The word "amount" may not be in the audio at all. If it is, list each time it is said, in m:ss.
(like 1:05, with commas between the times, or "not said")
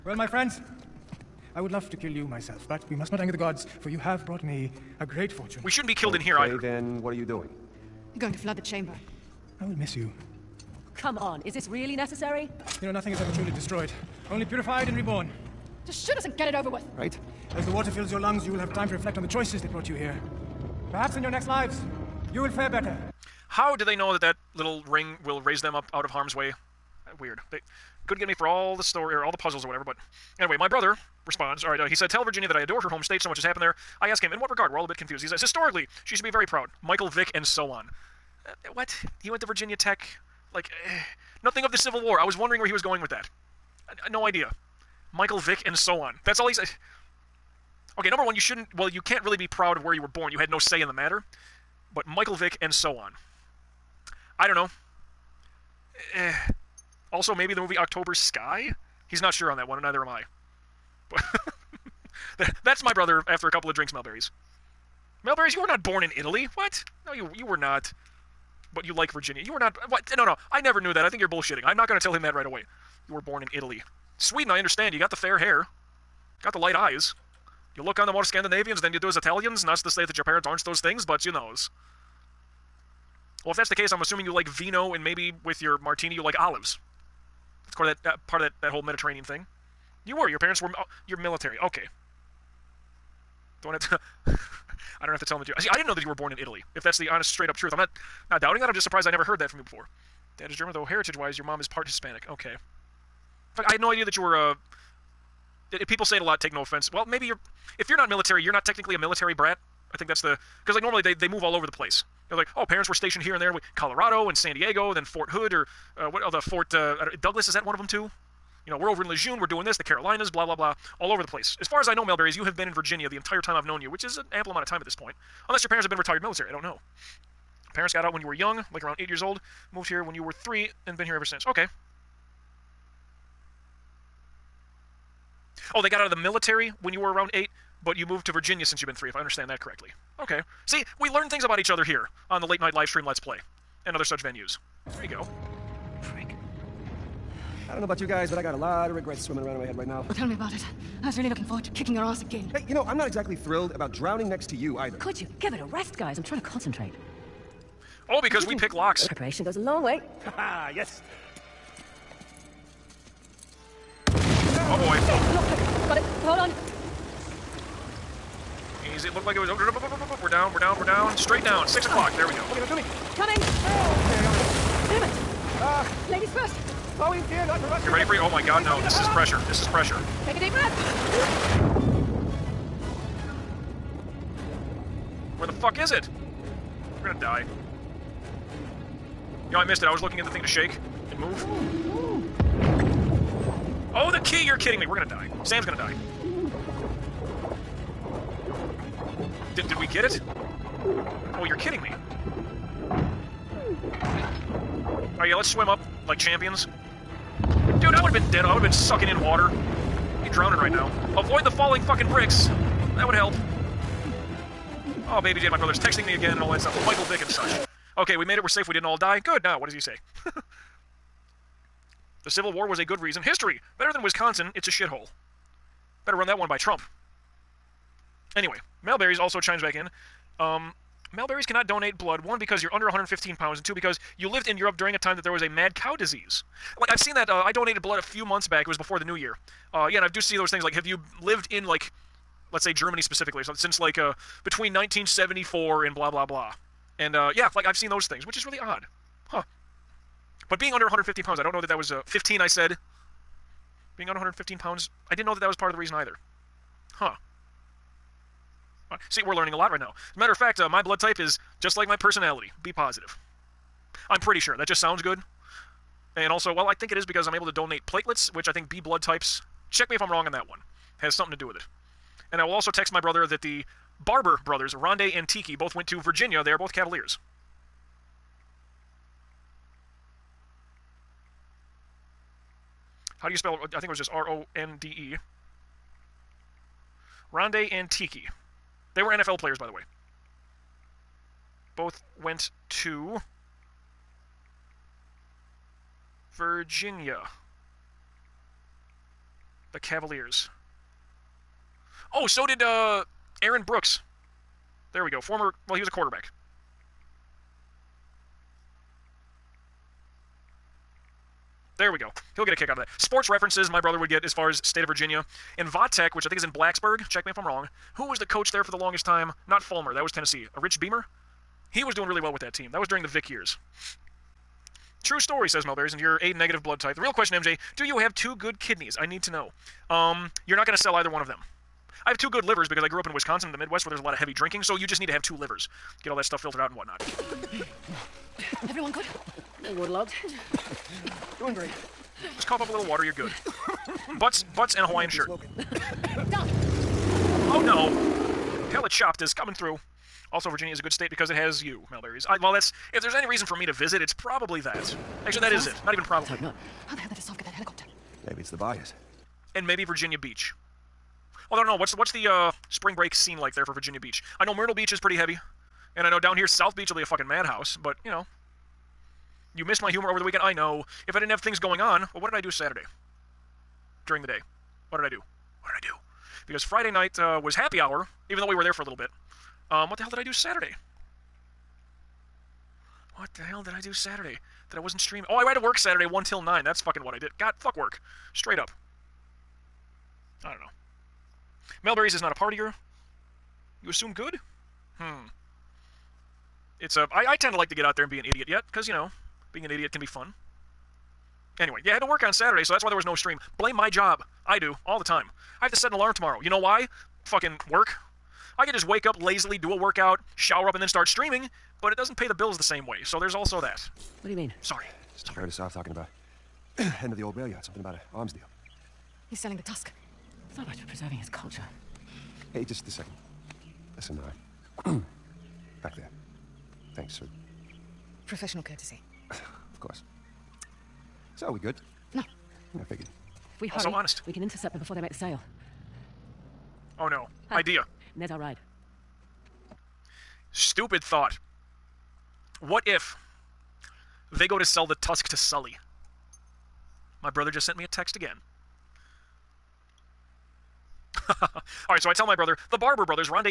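2:04.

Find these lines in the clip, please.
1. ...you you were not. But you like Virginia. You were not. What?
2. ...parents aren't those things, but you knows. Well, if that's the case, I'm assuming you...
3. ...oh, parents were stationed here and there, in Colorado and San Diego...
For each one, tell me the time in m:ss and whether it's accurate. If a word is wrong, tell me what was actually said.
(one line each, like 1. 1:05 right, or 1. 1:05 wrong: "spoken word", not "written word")
1. 1:07 right
2. 1:20 right
3. 1:52 right.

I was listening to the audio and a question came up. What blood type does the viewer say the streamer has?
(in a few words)
A negative.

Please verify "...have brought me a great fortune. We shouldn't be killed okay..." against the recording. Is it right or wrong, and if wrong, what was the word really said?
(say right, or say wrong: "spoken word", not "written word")
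right.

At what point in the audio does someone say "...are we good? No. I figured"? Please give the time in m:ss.
7:11.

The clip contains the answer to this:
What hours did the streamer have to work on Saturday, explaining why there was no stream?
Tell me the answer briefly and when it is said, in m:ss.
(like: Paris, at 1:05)
1 till 9, at 6:26.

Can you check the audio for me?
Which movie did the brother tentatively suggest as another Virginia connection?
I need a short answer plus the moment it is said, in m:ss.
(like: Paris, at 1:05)
October Sky, at 0:57.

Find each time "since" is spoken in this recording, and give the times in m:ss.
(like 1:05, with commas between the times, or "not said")
2:11, 2:18, 4:03.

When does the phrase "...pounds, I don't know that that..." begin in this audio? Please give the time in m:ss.
4:11.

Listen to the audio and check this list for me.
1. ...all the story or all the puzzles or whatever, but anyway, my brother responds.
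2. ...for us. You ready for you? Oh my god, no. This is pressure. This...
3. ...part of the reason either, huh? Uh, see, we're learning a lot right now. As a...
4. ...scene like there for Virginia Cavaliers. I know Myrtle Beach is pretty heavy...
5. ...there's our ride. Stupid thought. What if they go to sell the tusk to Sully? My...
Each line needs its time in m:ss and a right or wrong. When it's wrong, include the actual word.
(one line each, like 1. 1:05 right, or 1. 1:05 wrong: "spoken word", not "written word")
1. 0:28 right
2. 2:57 right
3. 4:15 right
4. 6:03 wrong: "Beach", not "Cavaliers"
5. 7:18 right.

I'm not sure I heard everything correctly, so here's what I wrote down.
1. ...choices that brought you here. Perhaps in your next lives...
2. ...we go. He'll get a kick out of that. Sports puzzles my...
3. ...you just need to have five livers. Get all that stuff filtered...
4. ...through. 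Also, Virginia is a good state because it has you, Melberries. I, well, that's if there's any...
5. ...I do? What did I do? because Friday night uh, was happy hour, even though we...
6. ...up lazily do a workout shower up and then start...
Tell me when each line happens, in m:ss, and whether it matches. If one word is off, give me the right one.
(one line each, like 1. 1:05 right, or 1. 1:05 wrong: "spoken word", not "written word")
1. 0:19 right
2. 5:11 wrong: "references", not "puzzles"
3. 5:34 wrong: "two", not "five"
4. 5:49 right
5. 6:15 right
6. 6:49 right.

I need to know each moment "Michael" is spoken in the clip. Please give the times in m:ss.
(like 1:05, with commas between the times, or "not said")
0:36, 0:45, 0:52, 3:36.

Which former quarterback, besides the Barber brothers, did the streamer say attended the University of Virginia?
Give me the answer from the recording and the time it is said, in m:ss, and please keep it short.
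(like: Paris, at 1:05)
Aaron Brooks, at 5:03.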